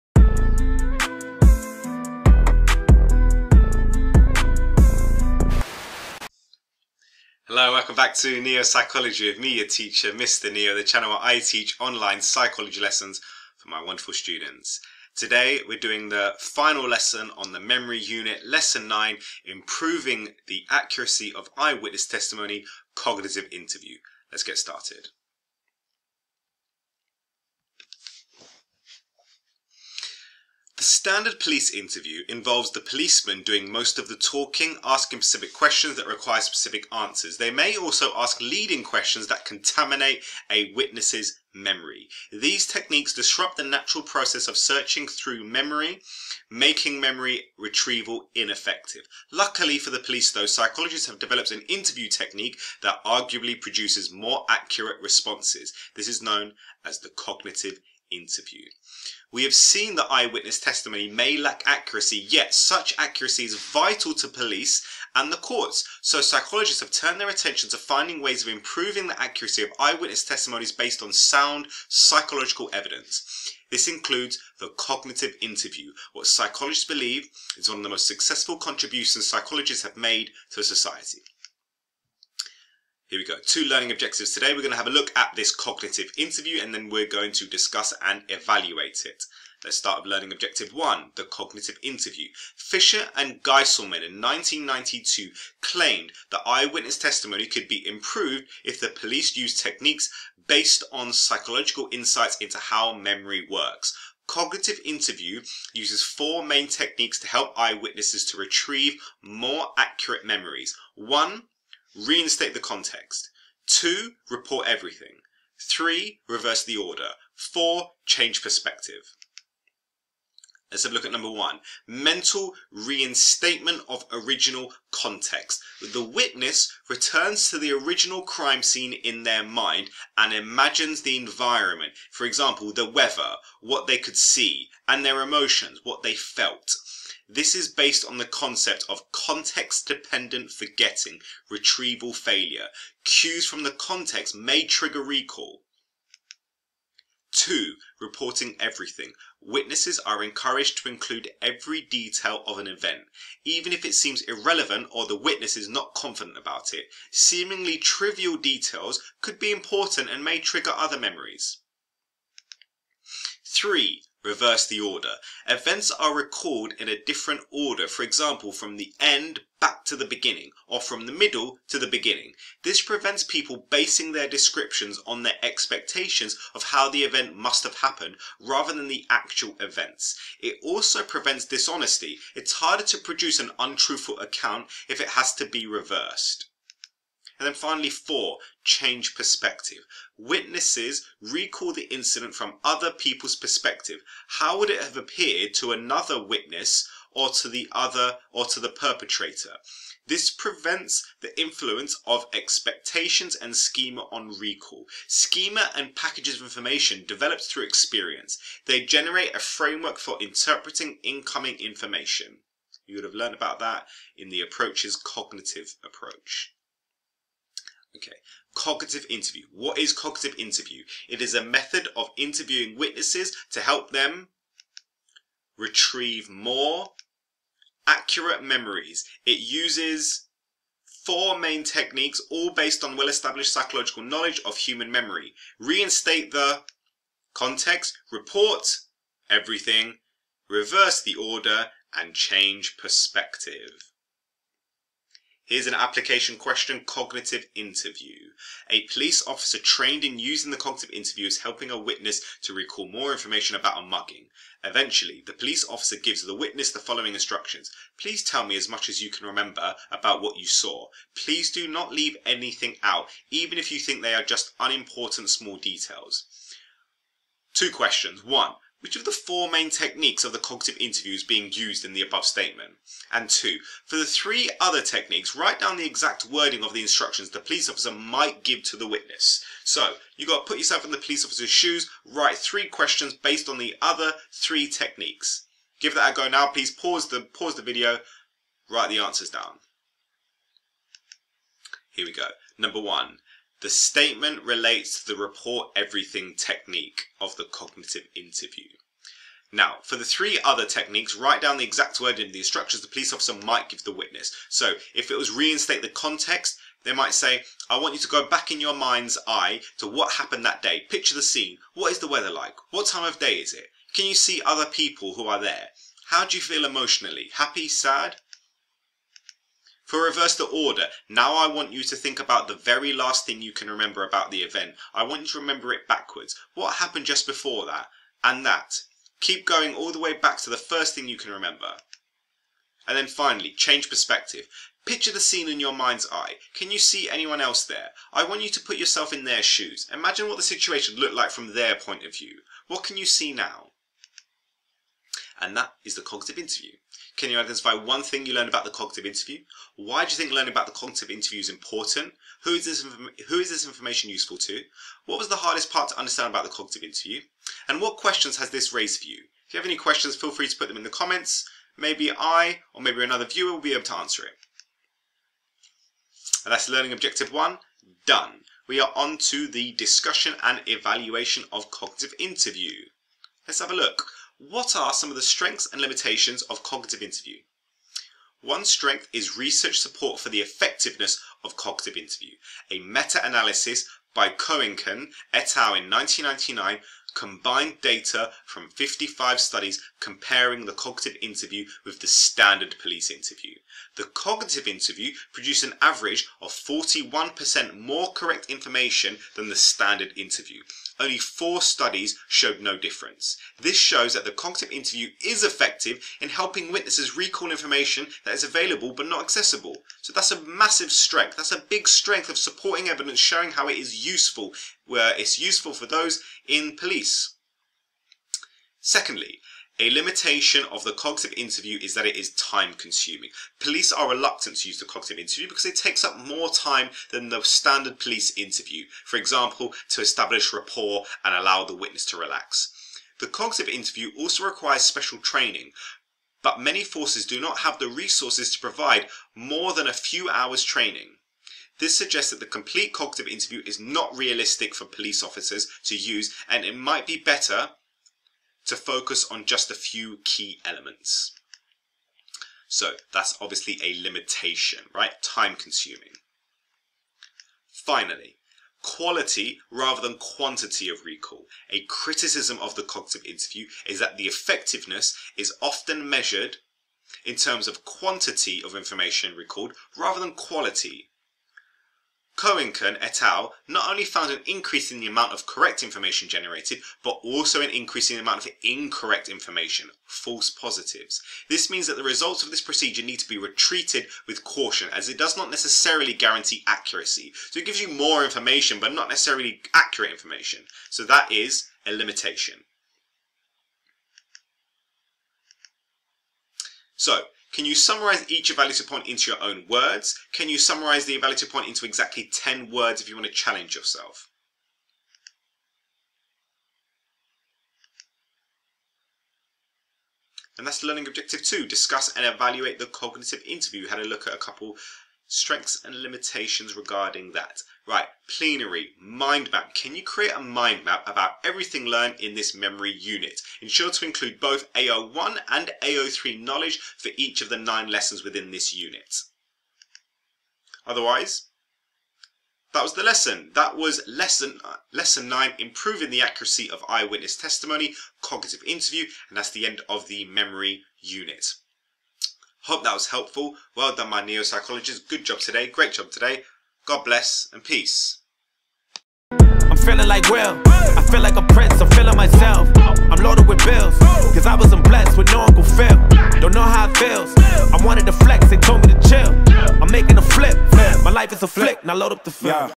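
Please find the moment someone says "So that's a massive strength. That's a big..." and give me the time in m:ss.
6:50.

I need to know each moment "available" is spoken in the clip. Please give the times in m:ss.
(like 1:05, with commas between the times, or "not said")
6:48.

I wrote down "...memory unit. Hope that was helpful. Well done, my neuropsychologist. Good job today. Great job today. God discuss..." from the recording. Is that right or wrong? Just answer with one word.
wrong.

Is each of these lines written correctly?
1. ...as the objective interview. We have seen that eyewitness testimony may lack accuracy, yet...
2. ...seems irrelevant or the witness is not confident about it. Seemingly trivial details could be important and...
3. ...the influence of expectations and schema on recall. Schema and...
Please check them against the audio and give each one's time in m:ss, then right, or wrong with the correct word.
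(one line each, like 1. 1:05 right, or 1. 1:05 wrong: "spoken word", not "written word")
1. 0:56 wrong: "cognitive", not "objective"
2. 2:33 right
3. 3:21 right.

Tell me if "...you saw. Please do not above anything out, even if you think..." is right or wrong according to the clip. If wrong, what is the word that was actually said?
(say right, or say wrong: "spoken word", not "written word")
wrong: "leave", not "above".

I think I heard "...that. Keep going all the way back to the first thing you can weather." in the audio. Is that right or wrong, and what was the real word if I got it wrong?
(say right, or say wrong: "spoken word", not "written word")
wrong: "remember", not "weather".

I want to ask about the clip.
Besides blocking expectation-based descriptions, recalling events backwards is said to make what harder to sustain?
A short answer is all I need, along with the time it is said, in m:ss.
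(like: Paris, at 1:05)
dishonesty, at 3:01.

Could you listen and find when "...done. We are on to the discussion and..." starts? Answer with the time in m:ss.
6:08.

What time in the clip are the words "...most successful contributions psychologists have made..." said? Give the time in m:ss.
1:17.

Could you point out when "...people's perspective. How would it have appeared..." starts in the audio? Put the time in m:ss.
3:12.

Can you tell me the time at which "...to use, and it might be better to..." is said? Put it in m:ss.
7:25.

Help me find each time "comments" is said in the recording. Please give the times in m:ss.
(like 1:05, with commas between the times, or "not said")
6:00.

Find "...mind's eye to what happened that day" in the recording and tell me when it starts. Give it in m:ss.
5:08.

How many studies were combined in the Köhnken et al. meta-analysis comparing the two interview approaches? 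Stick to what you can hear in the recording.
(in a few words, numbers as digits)
55.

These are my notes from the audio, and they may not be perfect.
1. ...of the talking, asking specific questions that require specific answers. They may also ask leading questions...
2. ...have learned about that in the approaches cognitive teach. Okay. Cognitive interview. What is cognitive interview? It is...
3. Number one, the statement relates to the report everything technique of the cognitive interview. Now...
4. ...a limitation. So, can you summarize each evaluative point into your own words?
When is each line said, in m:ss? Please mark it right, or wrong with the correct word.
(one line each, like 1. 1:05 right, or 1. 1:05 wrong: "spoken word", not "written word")
1. 0:33 right
2. 3:33 wrong: "approach", not "teach"
3. 4:52 right
4. 8:11 right.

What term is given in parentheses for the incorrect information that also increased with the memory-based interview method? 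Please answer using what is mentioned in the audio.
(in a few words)
false positives.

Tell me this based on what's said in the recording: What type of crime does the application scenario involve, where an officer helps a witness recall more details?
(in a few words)
a mugging.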